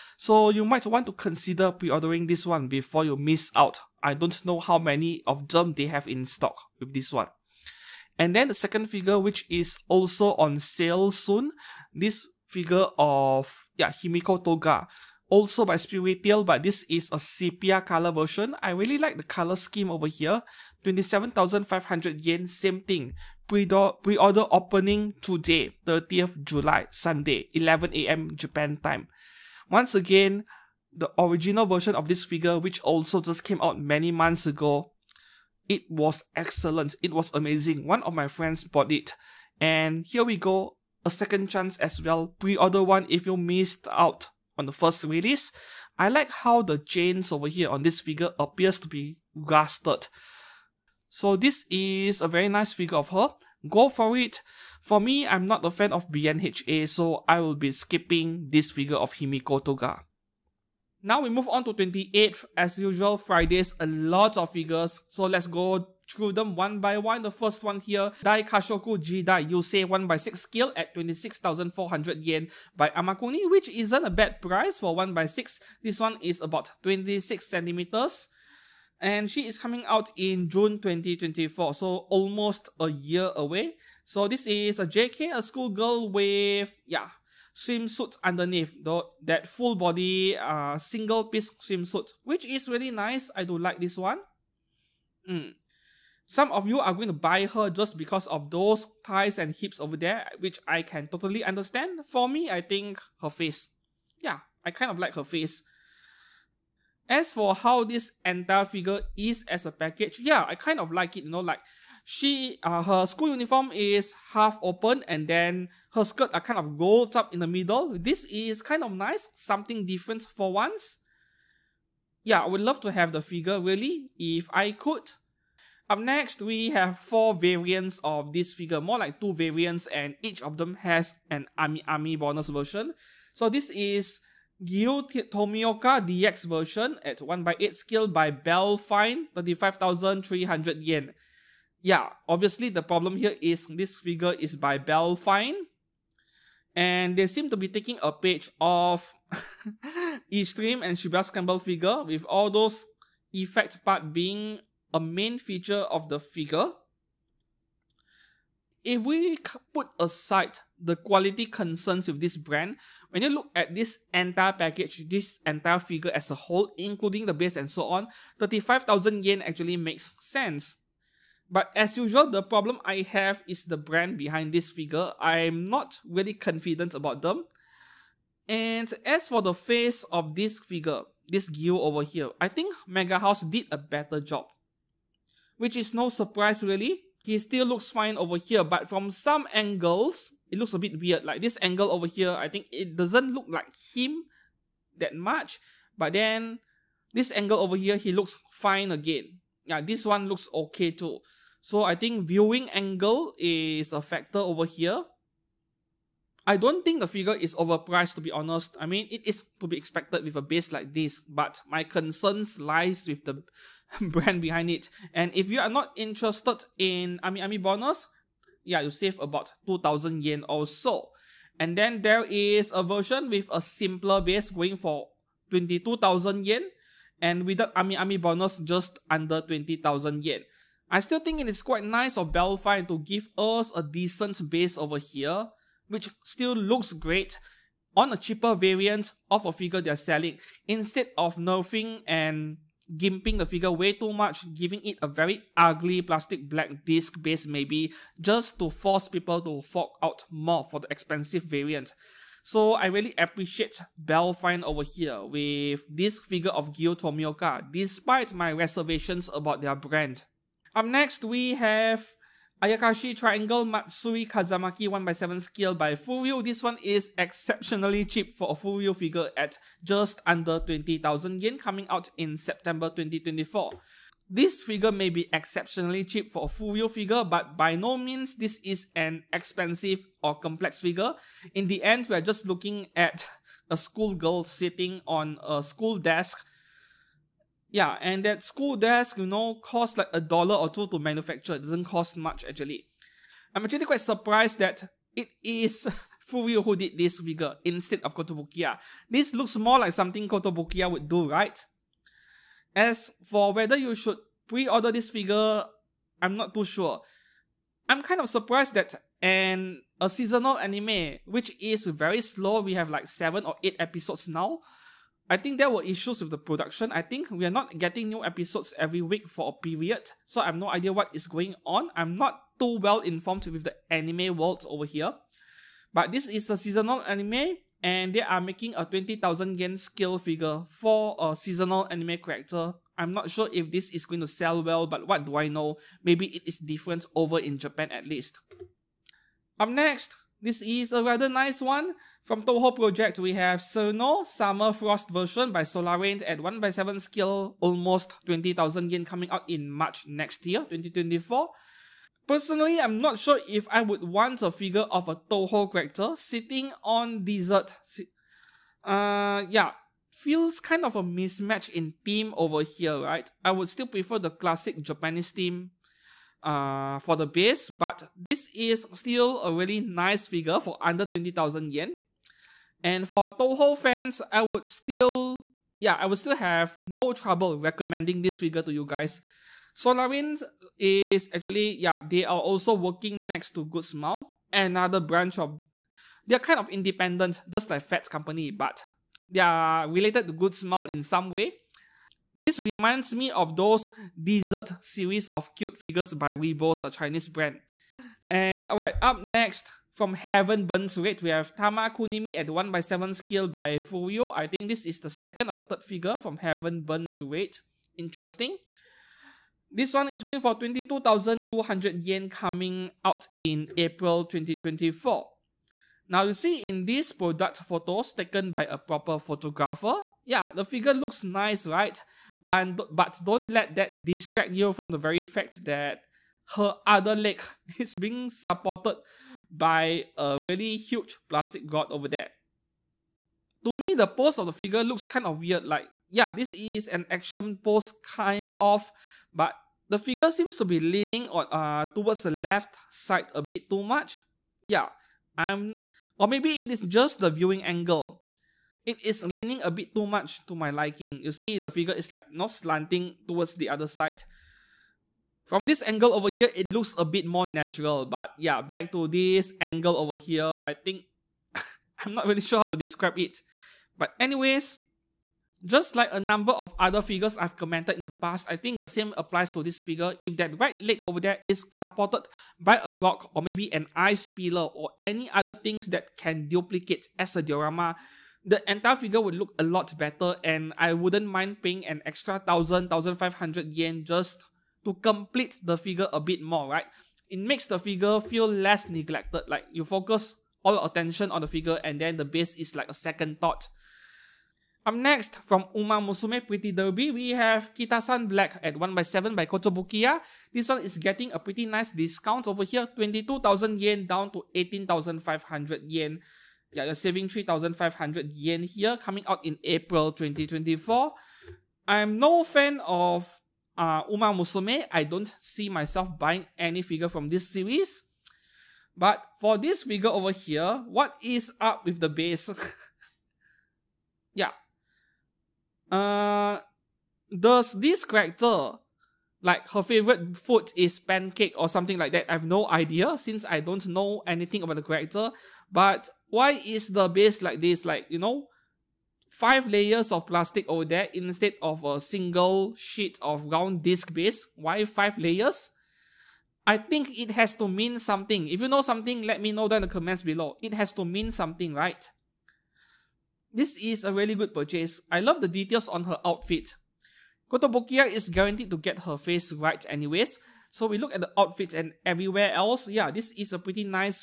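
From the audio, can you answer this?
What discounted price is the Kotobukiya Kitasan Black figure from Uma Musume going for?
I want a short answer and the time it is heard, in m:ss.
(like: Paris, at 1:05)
18,500 yen, at 8:24.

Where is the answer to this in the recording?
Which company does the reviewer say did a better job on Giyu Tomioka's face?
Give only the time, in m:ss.
3:02.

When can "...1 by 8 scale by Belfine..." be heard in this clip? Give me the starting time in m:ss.
2:17.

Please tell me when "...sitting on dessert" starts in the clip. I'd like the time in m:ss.
5:56.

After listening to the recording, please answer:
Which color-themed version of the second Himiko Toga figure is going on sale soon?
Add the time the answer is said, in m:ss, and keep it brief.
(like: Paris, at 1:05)
Sepia, at 0:17.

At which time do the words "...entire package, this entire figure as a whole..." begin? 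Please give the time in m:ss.
2:44.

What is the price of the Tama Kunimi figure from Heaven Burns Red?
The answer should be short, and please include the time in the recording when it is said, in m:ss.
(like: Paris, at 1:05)
22,200 yen, at 6:50.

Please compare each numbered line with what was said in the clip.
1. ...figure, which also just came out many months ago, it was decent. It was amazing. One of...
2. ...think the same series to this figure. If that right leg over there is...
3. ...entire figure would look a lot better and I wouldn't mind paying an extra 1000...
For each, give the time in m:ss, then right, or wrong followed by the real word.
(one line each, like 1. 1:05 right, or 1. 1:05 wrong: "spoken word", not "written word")
1. 0:32 wrong: "excellent", not "decent"
2. 7:48 wrong: "applies", not "series"
3. 7:58 right.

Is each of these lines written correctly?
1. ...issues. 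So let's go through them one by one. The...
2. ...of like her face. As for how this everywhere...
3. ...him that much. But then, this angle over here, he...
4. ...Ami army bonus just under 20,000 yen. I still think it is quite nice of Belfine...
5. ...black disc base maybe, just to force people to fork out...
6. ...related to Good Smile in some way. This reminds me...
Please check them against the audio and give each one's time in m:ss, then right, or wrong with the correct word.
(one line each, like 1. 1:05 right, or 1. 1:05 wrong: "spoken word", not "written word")
1. 1:04 wrong: "figures", not "issues"
2. 1:44 wrong: "entire", not "everywhere"
3. 3:13 right
4. 3:47 right
5. 4:06 right
6. 6:29 right.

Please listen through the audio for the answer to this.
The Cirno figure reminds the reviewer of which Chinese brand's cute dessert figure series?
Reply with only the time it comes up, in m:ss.
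6:36.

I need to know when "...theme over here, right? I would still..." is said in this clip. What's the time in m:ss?
6:02.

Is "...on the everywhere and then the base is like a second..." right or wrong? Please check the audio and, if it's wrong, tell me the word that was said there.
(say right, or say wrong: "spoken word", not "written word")
wrong: "figure", not "everywhere".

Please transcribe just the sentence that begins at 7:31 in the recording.
You see, the figure is like not slanting towards the other side.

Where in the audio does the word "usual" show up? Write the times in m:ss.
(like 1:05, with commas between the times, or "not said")
1:02, 2:51.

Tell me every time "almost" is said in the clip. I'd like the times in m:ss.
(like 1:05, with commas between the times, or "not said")
1:22, 5:47.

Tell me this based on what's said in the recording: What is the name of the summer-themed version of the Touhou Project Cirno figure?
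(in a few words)
Summer Frost.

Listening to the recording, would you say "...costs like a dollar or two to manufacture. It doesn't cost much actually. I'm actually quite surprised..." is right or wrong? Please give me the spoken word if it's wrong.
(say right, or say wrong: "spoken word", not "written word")
right.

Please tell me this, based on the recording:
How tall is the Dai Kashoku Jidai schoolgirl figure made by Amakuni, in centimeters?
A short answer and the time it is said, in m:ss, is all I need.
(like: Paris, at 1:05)
26 centimeters, at 1:16.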